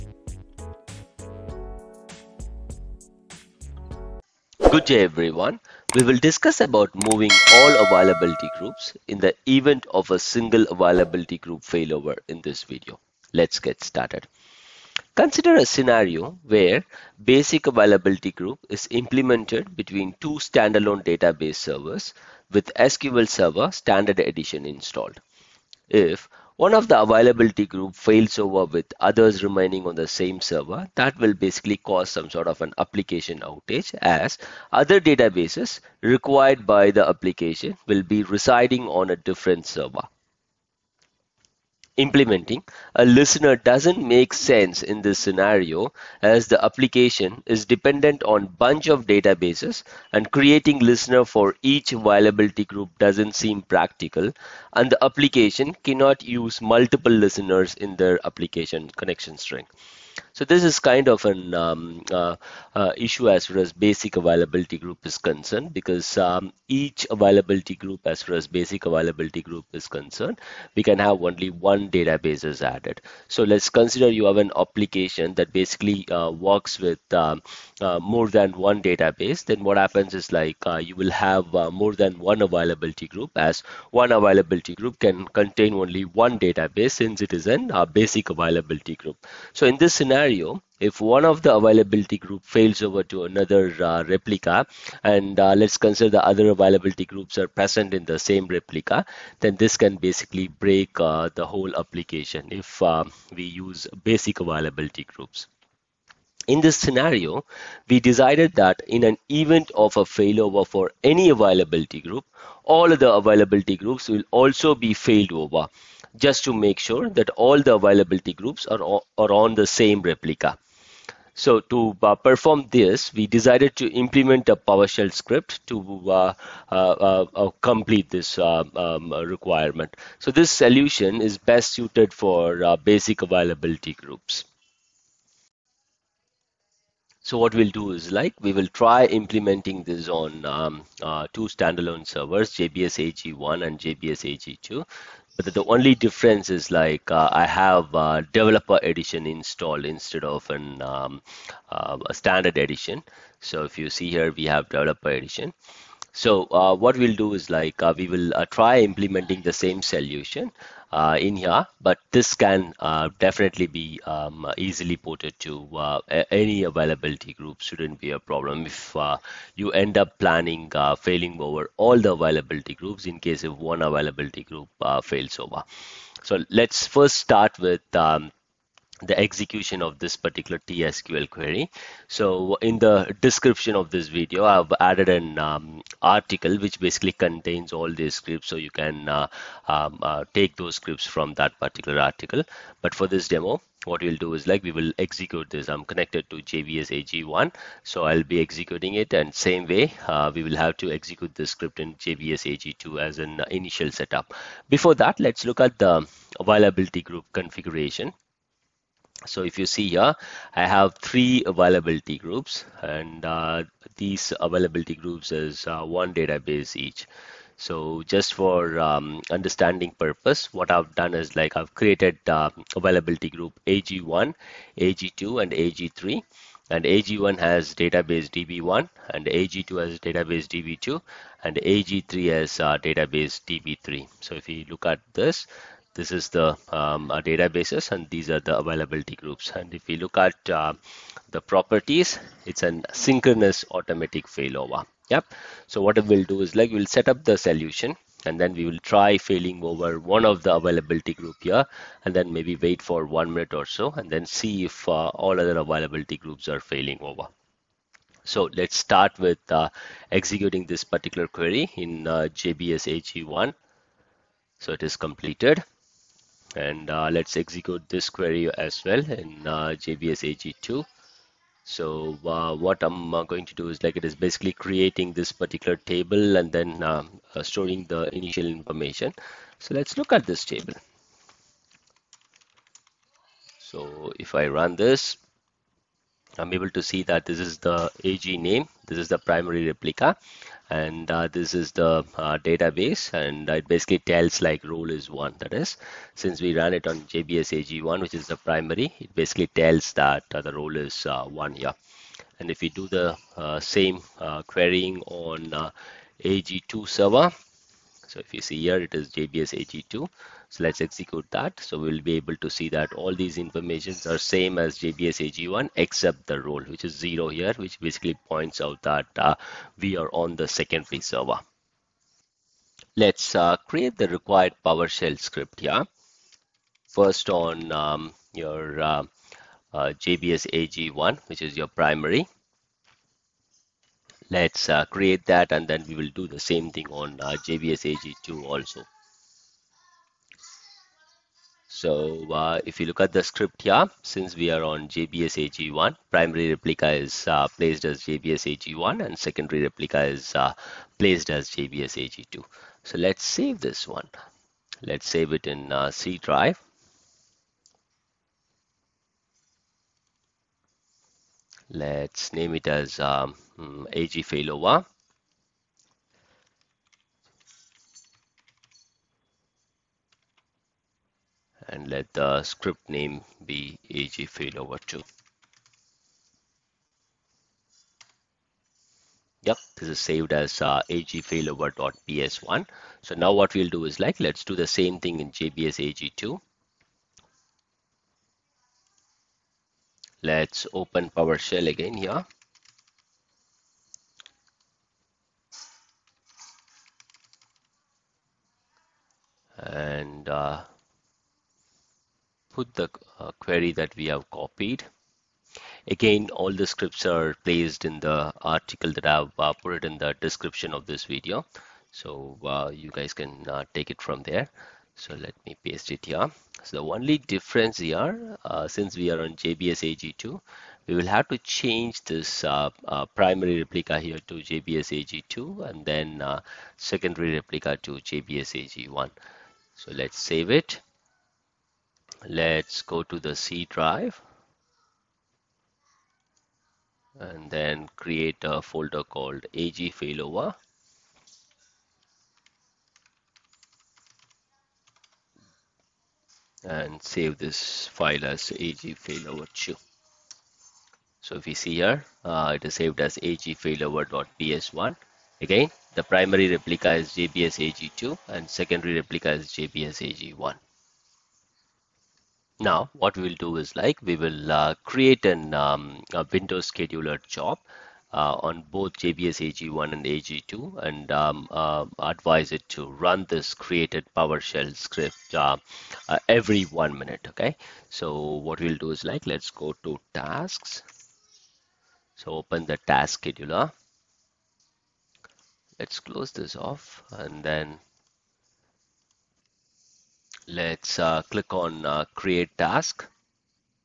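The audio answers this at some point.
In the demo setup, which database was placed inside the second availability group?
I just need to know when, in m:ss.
3:50.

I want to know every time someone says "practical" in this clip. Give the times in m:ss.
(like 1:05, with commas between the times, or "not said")
0:53.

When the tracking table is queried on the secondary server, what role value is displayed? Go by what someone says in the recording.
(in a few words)
0.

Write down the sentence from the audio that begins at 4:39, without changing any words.
So let's look at this table.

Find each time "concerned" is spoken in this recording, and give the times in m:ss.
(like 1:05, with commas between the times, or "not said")
1:05, 1:09.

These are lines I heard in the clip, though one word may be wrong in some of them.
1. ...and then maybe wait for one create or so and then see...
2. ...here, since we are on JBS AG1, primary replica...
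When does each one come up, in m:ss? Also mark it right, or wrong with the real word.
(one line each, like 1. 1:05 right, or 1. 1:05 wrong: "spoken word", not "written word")
1. 4:12 wrong: "minute", not "create"
2. 5:43 right.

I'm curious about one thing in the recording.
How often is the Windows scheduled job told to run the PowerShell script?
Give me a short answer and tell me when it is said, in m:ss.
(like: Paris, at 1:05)
Every one minute, at 7:56.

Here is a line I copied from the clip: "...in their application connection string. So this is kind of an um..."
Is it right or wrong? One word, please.
right.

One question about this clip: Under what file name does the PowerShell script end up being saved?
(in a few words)
agfailover.ps1.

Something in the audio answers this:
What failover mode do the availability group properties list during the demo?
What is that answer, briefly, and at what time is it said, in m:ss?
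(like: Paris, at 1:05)
Synchronous automatic failover, at 4:02.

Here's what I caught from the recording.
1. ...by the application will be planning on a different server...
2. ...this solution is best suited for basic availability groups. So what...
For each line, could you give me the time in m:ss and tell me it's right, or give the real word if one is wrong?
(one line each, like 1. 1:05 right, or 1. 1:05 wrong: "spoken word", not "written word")
1. 0:36 wrong: "residing", not "planning"
2. 2:10 right.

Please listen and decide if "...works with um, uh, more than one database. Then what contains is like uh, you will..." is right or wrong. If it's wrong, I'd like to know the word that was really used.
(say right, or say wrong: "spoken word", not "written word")
wrong: "happens", not "contains".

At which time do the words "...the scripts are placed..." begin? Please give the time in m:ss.
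6:46.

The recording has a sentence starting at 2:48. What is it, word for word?
If you end up planning failing over all the availability groups in case if one availability group fails over.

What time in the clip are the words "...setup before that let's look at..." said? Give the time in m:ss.
3:23.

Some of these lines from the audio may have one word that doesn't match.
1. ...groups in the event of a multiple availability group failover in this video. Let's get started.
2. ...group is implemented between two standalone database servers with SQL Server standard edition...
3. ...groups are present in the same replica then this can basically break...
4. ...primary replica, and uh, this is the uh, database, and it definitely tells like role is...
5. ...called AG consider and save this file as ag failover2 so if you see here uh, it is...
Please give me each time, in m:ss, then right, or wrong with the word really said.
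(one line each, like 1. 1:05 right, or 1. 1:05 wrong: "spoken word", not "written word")
1. 0:08 wrong: "single", not "multiple"
2. 0:18 right
3. 1:37 right
4. 4:49 wrong: "basically", not "definitely"
5. 7:19 wrong: "failover", not "consider".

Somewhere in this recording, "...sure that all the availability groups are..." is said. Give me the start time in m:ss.
1:56.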